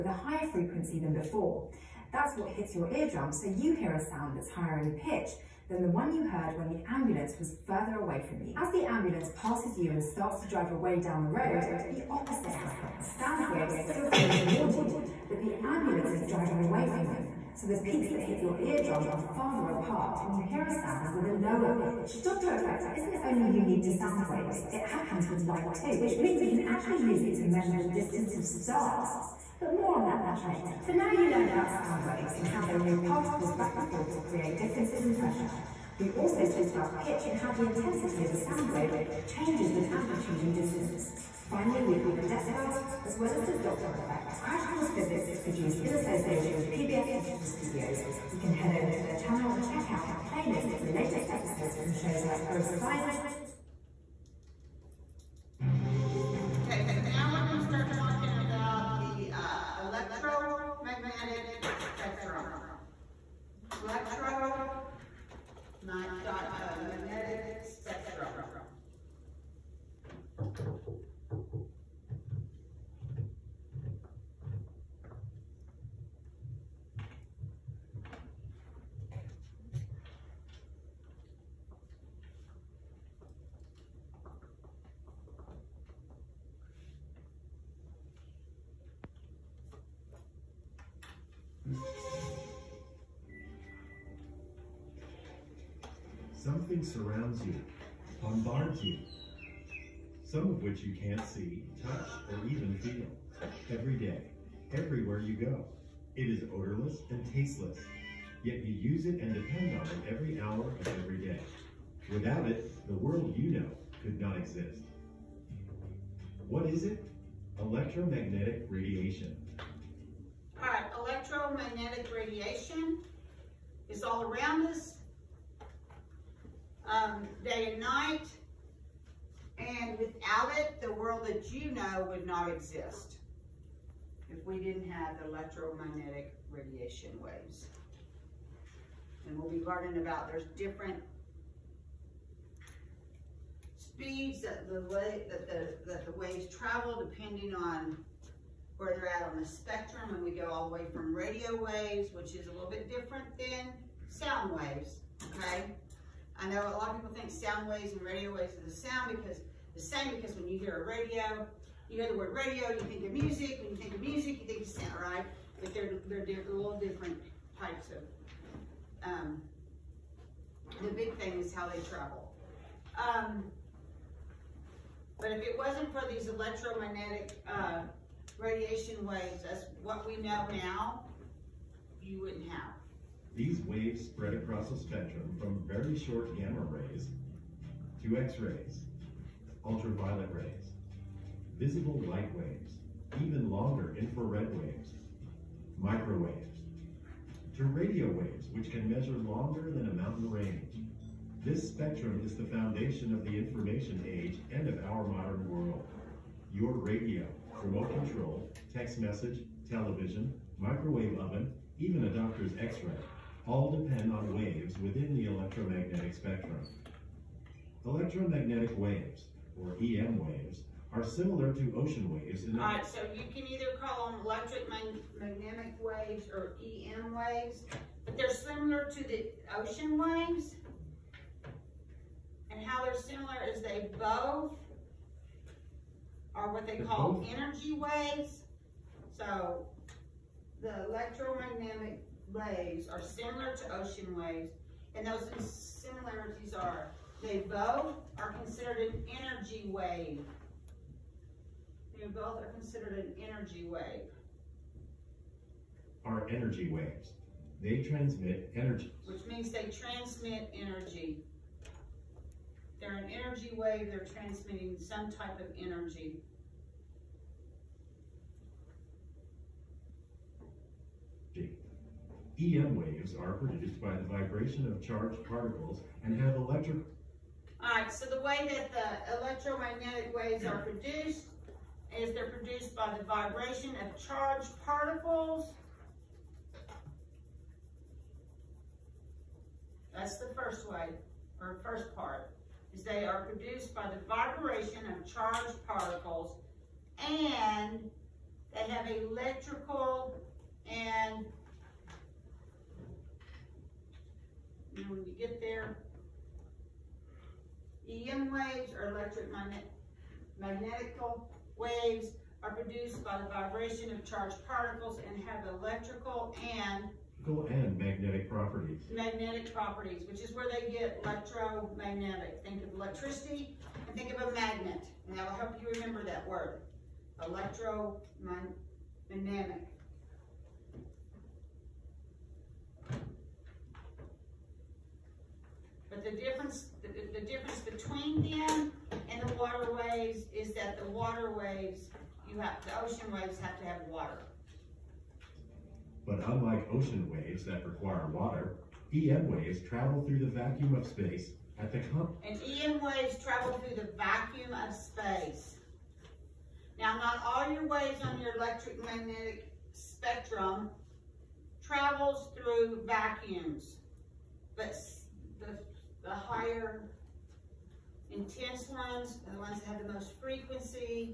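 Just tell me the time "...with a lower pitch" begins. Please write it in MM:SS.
00:21.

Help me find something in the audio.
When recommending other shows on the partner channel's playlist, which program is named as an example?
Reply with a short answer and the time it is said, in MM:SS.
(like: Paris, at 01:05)
Gross Science, at 00:52.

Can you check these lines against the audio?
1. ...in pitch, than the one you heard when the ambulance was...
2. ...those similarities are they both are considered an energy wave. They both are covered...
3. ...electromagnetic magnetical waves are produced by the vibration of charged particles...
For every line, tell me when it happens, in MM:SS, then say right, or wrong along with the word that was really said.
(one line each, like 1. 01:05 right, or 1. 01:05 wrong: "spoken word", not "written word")
1. 00:04 right
2. 04:05 wrong: "considered", not "covered"
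3. 05:08 right.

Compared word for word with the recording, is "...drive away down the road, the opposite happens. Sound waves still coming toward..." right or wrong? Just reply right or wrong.
right.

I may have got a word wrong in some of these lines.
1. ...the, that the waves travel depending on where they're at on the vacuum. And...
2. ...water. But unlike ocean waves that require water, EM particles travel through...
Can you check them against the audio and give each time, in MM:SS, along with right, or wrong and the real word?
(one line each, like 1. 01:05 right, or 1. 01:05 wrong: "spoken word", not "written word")
1. 02:25 wrong: "spectrum", not "vacuum"
2. 05:43 wrong: "waves", not "particles".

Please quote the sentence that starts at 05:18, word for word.
Magnetic properties, which is where they get electromagnetic.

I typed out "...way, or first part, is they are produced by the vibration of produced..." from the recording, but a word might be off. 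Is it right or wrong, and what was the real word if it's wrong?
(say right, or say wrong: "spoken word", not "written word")
wrong: "charged", not "produced".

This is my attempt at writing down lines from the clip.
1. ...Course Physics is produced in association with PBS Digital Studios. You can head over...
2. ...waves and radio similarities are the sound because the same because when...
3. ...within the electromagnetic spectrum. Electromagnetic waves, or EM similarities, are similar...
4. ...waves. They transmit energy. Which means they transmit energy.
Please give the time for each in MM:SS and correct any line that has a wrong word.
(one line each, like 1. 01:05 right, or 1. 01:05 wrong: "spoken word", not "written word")
1. 00:44 right
2. 02:37 wrong: "waves", not "similarities"
3. 03:34 wrong: "waves", not "similarities"
4. 04:16 right.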